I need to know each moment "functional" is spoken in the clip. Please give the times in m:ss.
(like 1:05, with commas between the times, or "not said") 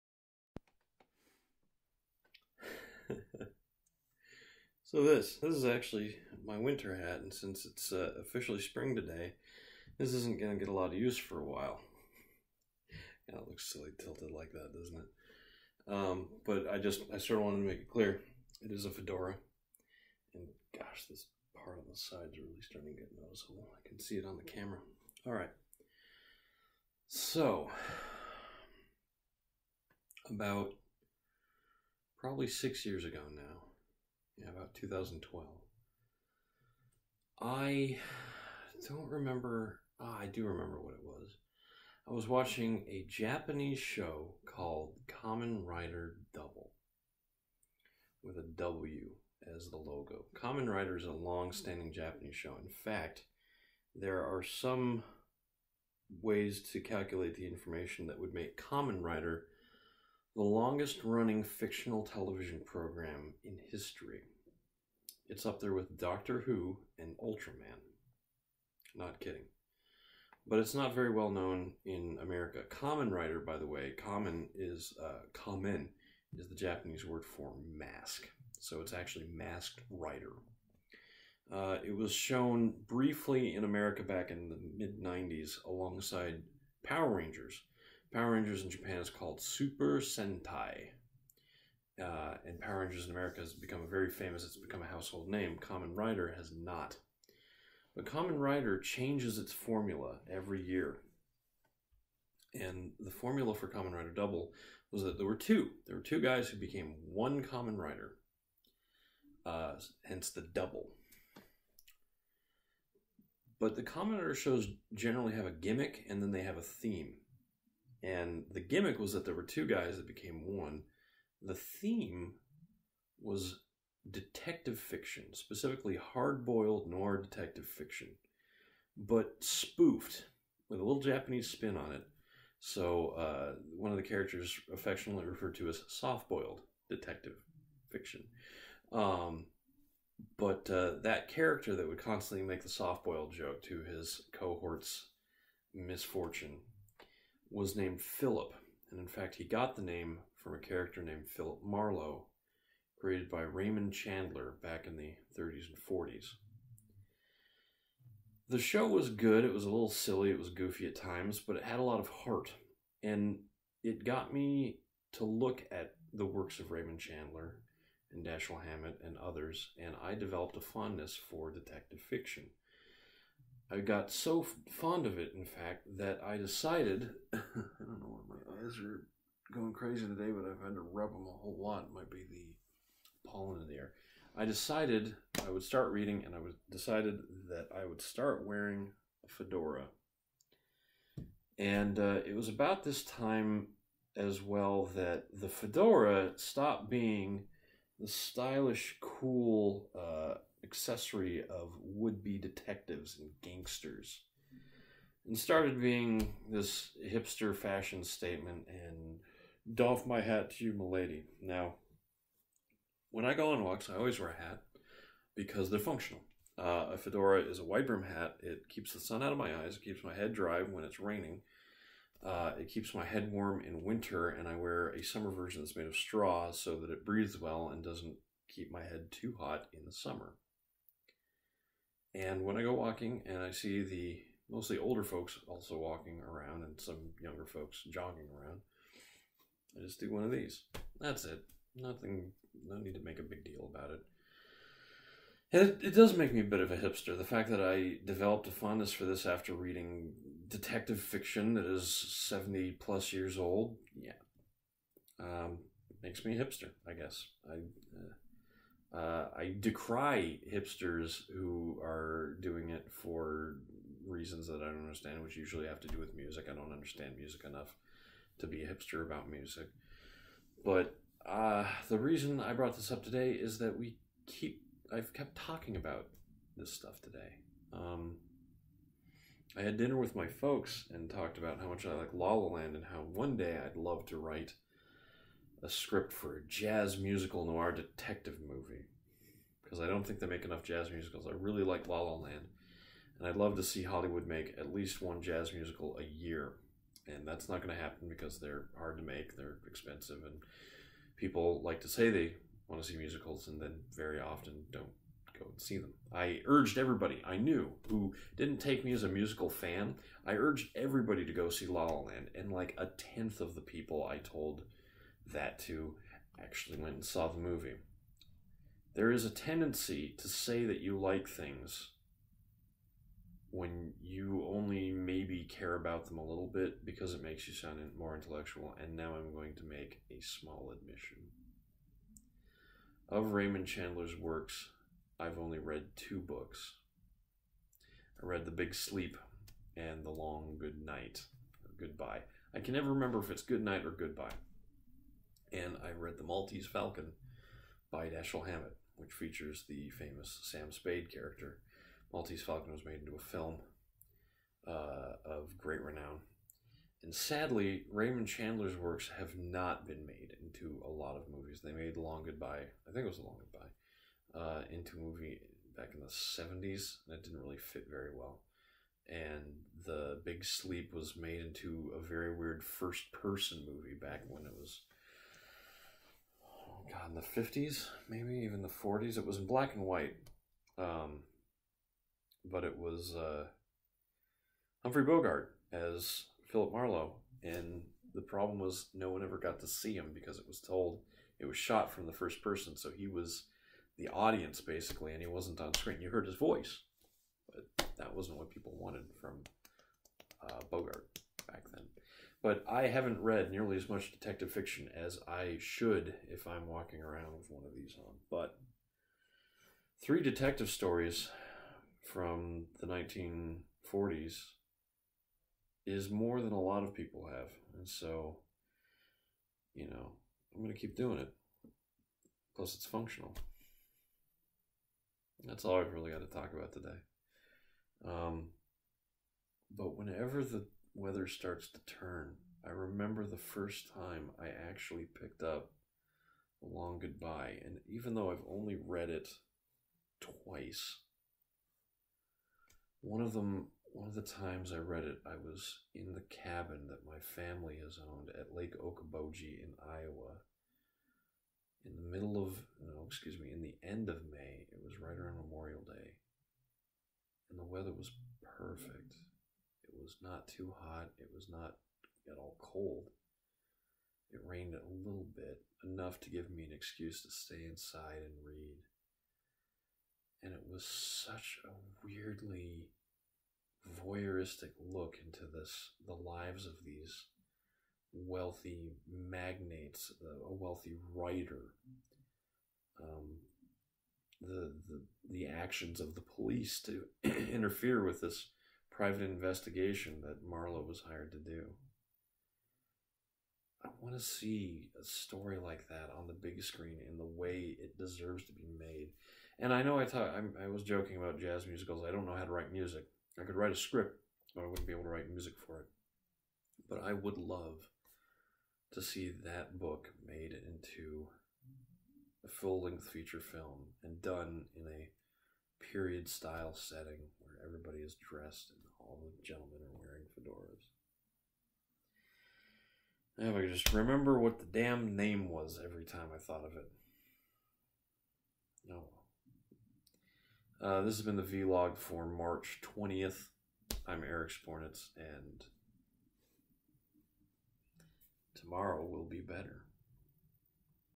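3:35, 7:02.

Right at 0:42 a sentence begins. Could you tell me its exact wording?
I was watching a Japanese show called Kamen Rider Double with a W as the logo.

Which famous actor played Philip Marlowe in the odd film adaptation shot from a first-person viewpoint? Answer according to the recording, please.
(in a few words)
Humphrey Bogart.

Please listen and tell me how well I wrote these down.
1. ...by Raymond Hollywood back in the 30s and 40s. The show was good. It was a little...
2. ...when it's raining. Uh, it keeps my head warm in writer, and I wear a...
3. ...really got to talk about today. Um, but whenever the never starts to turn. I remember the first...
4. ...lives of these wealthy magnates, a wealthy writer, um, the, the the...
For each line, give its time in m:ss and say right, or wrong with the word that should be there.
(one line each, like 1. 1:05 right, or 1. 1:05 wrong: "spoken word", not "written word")
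1. 2:33 wrong: "Chandler", not "Hollywood"
2. 3:40 wrong: "winter", not "writer"
3. 7:05 wrong: "weather", not "never"
4. 7:56 right.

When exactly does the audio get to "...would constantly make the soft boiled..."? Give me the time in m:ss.
2:21.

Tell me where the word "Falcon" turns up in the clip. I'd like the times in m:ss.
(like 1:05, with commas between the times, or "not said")
5:46, 5:52.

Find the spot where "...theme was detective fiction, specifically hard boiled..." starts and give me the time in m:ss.
2:01.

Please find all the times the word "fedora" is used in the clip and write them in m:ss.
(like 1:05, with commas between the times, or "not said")
0:18, 3:09, 3:15, 3:36, 8:40.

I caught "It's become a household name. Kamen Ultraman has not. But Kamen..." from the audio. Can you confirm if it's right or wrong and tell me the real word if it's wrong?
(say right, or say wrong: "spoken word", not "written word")
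wrong: "Rider", not "Ultraman".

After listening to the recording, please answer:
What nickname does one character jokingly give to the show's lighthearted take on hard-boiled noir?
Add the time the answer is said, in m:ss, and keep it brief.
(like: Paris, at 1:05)
soft boiled detective fiction, at 2:15.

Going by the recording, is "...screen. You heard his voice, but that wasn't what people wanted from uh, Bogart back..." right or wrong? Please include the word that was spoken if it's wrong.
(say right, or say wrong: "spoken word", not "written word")
right.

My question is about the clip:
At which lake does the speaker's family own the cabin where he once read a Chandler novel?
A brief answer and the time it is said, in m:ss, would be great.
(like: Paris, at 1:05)
Lake Okoboji, at 7:28.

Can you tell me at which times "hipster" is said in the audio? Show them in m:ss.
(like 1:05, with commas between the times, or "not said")
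3:27, 4:06, 4:16, 4:20, 4:28.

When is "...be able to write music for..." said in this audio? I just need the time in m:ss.
8:24.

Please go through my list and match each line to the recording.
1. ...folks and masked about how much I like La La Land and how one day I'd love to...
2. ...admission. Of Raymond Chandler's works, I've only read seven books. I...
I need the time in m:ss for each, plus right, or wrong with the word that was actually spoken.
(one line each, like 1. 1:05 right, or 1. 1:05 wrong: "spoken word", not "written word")
1. 4:40 wrong: "talked", not "masked"
2. 5:30 wrong: "two", not "seven".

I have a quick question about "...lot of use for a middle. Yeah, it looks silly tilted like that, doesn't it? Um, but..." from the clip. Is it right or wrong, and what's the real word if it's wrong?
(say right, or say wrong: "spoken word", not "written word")
wrong: "while", not "middle".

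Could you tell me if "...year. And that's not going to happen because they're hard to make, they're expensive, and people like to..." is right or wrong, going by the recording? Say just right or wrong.
right.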